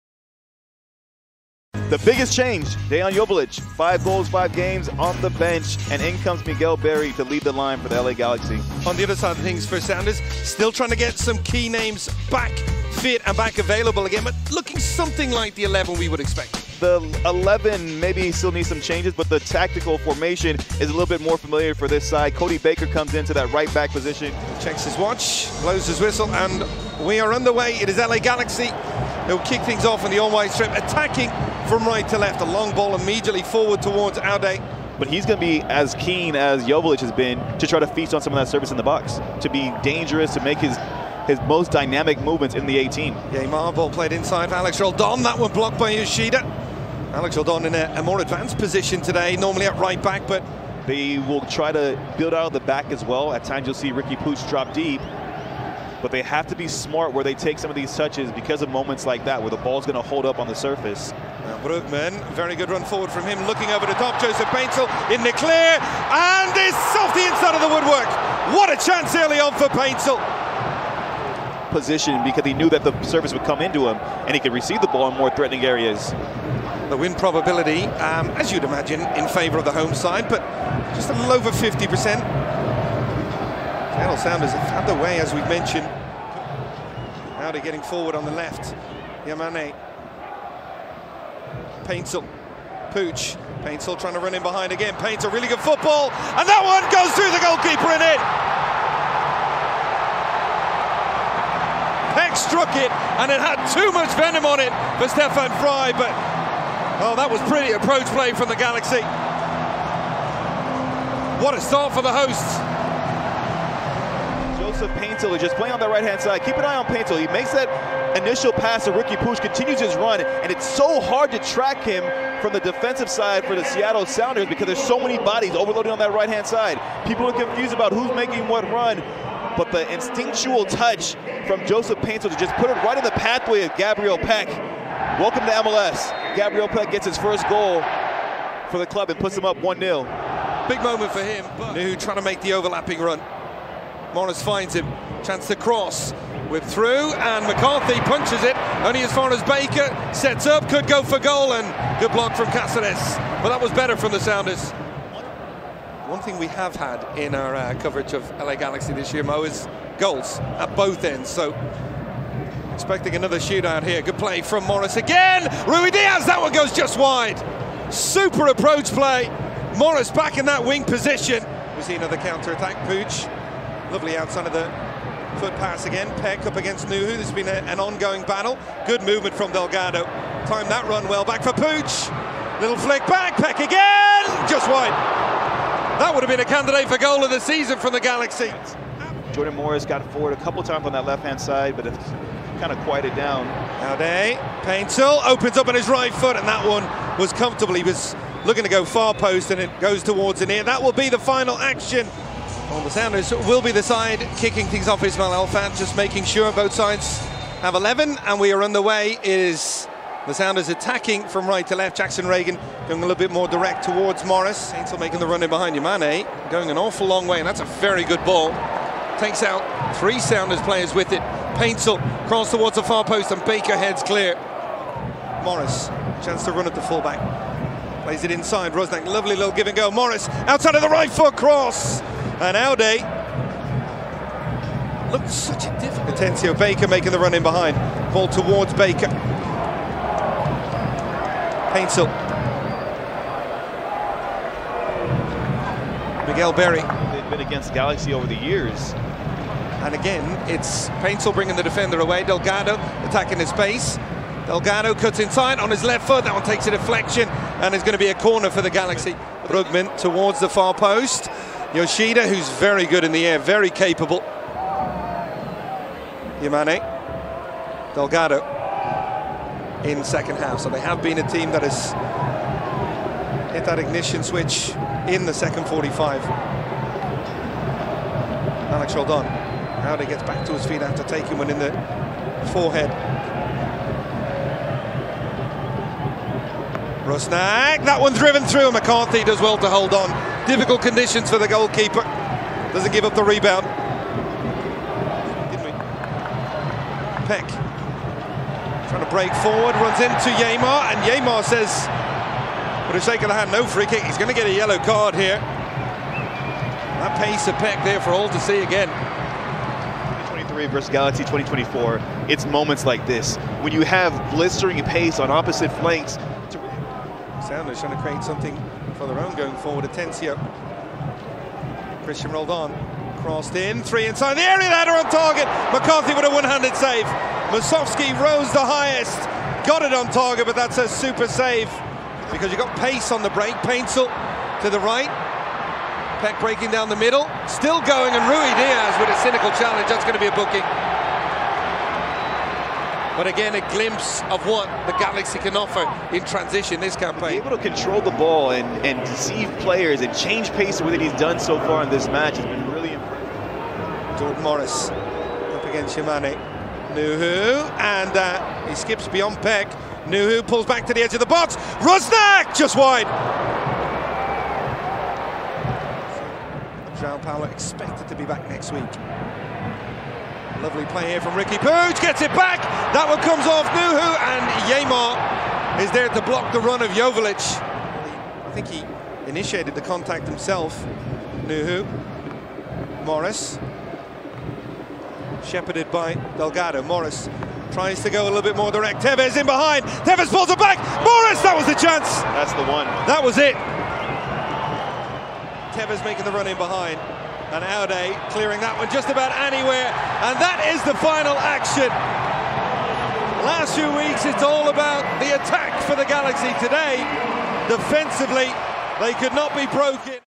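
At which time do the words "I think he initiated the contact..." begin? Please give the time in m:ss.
6:18.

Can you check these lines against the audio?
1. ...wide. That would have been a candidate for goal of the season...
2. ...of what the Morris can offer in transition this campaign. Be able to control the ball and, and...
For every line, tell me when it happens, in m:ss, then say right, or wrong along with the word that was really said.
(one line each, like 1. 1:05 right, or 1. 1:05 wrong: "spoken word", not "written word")
1. 3:04 right
2. 5:44 wrong: "Galaxy", not "Morris".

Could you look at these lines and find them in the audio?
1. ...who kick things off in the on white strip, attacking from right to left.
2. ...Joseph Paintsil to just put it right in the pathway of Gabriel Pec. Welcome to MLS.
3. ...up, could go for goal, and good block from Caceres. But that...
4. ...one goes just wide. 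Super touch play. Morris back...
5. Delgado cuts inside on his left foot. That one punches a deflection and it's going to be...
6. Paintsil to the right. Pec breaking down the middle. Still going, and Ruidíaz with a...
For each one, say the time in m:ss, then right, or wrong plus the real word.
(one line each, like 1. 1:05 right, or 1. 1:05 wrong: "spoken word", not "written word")
1. 0:29 right
2. 2:11 right
3. 2:30 right
4. 2:46 wrong: "approach", not "touch"
5. 4:14 wrong: "takes", not "punches"
6. 5:33 right.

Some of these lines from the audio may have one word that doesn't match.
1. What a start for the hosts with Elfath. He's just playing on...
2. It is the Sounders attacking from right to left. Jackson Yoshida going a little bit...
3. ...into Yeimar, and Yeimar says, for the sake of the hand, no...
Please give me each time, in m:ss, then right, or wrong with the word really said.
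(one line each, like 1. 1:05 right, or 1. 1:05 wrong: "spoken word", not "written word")
1. 1:51 wrong: "Paintsil", not "Elfath"
2. 3:29 wrong: "Ragen", not "Yoshida"
3. 5:00 right.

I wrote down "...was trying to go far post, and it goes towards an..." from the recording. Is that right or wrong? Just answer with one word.
wrong.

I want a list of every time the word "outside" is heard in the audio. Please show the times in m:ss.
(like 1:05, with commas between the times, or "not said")
2:54, 3:50.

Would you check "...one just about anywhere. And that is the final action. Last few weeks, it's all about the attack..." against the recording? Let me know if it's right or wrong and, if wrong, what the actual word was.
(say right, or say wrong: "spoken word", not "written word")
right.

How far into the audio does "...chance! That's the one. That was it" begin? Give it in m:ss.
6:31.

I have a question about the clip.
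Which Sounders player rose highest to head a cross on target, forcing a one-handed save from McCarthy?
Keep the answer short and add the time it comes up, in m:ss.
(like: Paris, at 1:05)
Musovski, at 5:27.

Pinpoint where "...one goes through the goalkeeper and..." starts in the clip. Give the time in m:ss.
1:36.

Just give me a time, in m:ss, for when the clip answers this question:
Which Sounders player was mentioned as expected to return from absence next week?
6:06.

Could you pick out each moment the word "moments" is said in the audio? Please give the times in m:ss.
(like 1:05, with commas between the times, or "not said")
0:58, 2:20, 5:12.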